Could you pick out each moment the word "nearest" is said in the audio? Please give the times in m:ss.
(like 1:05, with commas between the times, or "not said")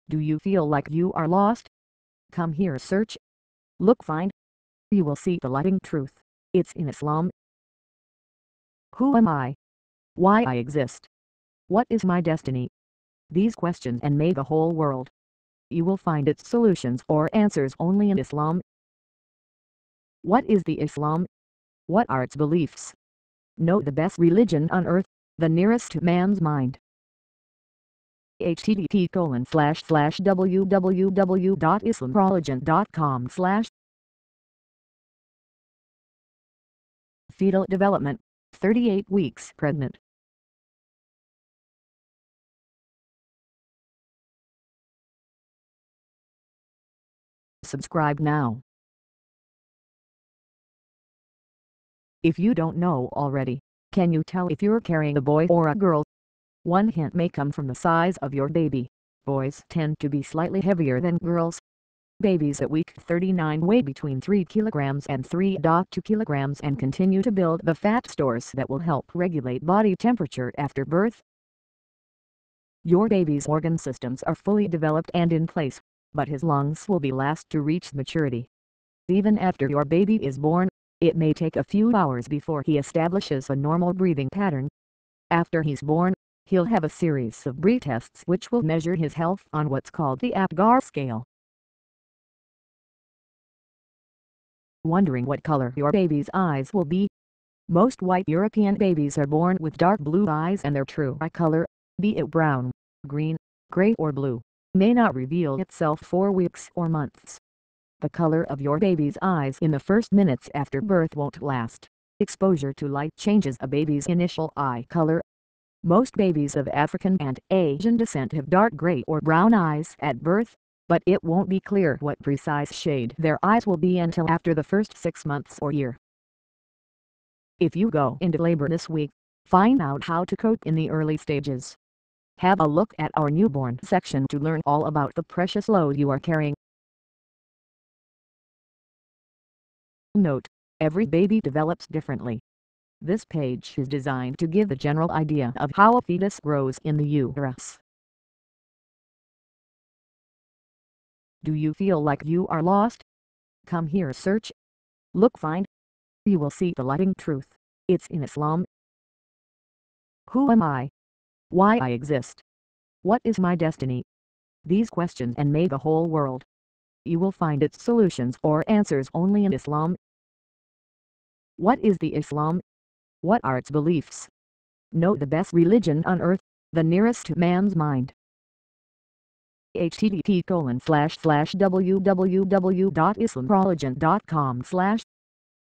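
0:25, 2:56.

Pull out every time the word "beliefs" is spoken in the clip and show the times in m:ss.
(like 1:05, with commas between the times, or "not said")
0:22, 2:53.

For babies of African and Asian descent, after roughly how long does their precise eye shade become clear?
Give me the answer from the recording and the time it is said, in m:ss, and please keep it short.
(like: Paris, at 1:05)
Six months, at 2:04.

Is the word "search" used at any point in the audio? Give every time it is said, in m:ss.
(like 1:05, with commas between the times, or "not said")
0:02, 2:34.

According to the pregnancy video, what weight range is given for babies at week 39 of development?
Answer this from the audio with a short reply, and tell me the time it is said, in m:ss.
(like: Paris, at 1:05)
3 kg to 3.2 kg, at 1:04.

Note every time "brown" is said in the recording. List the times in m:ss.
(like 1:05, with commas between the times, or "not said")
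1:42, 1:59.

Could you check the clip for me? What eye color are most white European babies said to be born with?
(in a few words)
Dark blue.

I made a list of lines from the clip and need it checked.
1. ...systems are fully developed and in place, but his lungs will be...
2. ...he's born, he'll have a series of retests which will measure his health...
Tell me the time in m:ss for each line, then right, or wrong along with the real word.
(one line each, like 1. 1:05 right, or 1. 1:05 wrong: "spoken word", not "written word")
1. 1:13 right
2. 1:25 right.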